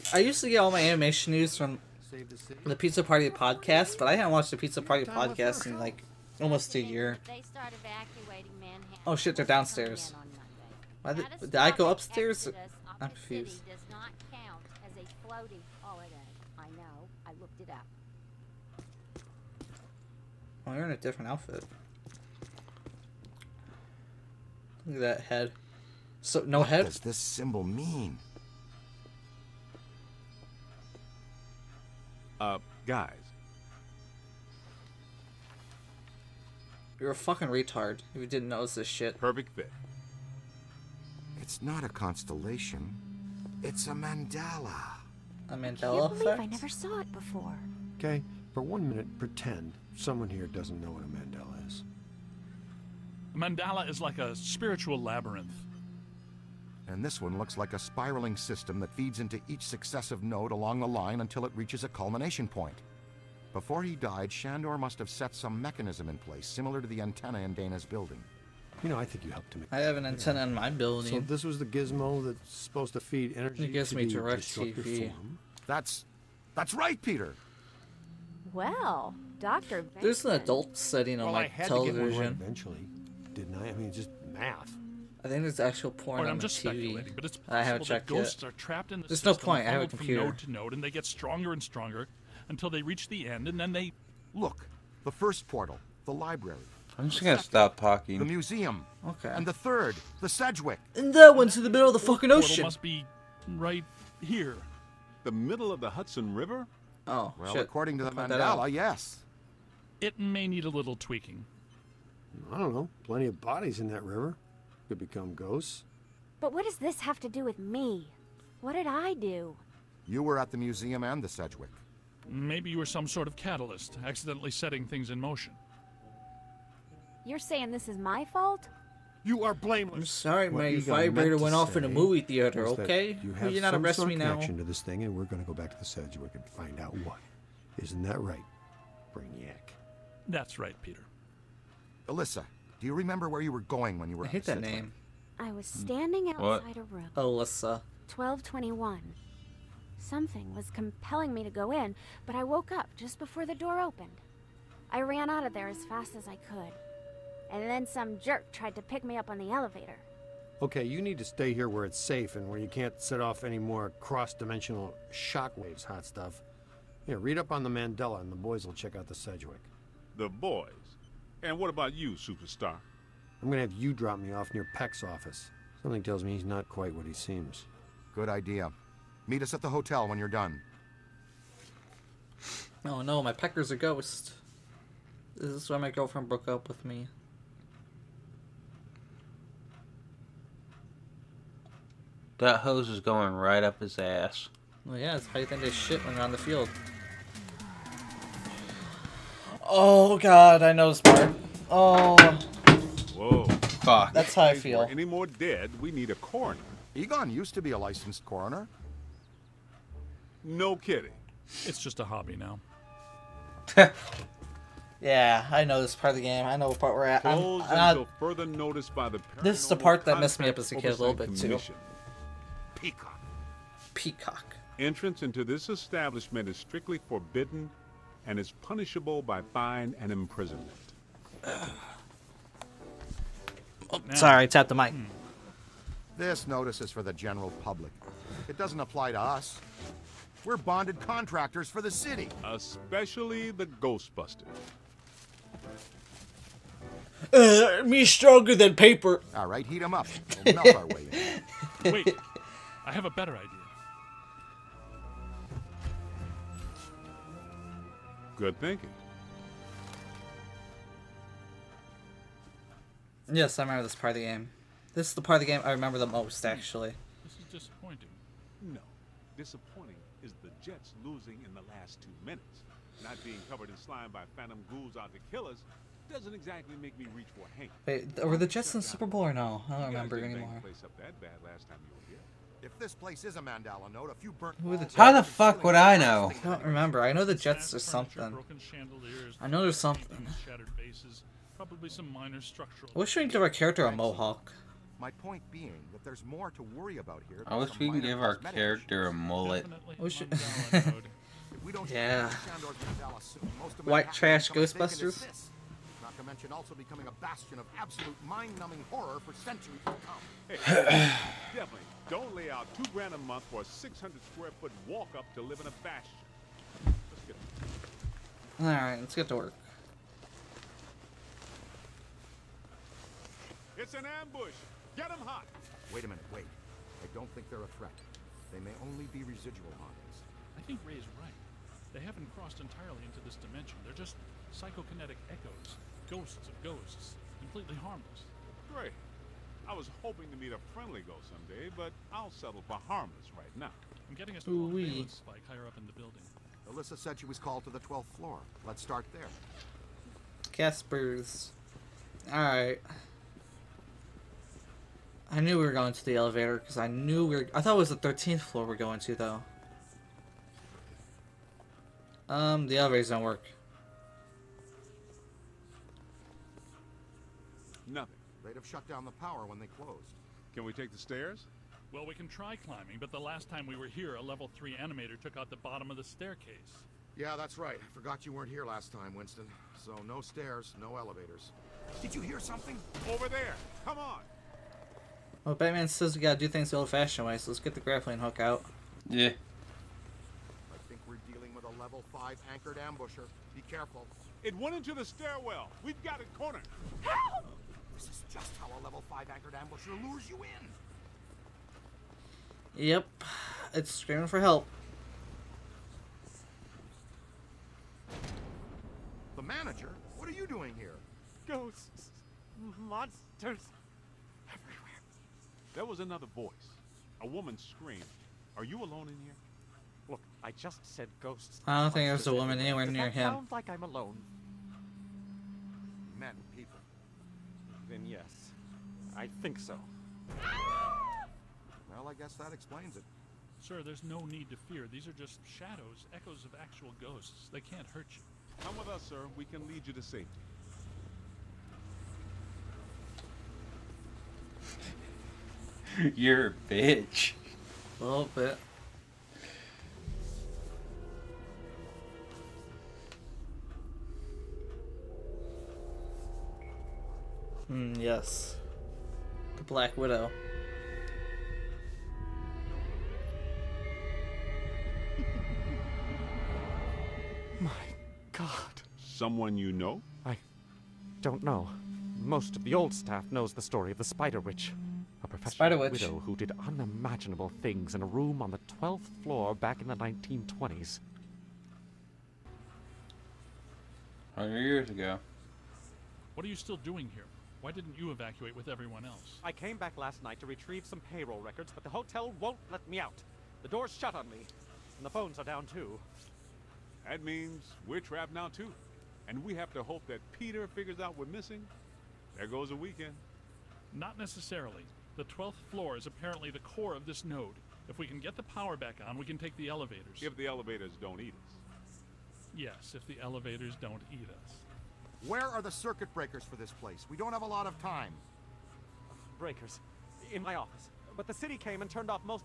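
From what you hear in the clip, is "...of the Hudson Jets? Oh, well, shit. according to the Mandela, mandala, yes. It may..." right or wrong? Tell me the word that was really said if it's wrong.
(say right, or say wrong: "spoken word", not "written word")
wrong: "River", not "Jets".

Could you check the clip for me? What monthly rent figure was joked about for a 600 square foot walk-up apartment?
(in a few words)
Two grand.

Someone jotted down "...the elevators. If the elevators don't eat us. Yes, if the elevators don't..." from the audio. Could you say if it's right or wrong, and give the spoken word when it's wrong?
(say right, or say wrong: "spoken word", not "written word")
right.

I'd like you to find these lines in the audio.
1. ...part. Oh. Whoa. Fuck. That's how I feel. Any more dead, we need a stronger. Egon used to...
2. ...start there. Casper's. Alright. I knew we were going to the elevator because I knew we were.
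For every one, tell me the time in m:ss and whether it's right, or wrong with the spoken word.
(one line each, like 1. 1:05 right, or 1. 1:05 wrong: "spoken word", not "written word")
1. 3:21 wrong: "coroner", not "stronger"
2. 5:48 right.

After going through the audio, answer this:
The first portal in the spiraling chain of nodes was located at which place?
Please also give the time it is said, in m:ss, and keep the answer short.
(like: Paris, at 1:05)
The library, at 1:35.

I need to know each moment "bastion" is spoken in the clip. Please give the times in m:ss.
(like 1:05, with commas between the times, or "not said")
5:07, 5:15.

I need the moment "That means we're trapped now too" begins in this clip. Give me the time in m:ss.
8:17.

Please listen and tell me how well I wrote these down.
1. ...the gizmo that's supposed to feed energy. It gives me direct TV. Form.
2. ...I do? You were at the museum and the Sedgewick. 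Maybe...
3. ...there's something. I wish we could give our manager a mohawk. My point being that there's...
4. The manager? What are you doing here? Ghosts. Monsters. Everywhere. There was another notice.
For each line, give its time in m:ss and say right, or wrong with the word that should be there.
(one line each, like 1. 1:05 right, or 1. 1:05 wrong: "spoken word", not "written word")
1. 1:11 right
2. 1:58 right
3. 4:49 wrong: "character", not "manager"
4. 6:49 wrong: "voice", not "notice".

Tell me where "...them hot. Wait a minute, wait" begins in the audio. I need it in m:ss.
5:25.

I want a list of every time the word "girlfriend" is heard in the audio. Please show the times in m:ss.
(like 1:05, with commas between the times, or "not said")
3:05.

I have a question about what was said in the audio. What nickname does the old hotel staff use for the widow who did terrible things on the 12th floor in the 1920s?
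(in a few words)
The Spider Witch.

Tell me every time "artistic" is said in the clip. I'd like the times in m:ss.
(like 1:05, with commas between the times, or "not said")
not said.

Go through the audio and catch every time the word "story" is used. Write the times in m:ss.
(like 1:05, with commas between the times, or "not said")
7:53.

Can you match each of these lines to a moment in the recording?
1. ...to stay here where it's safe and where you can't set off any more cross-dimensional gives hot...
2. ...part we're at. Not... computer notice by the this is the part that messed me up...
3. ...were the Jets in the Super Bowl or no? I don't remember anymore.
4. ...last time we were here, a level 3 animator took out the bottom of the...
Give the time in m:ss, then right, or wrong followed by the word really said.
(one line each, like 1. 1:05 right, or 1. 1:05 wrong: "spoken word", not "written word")
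1. 2:41 wrong: "shockwaves", not "gives"
2. 3:36 wrong: "further", not "computer"
3. 4:38 right
4. 6:13 right.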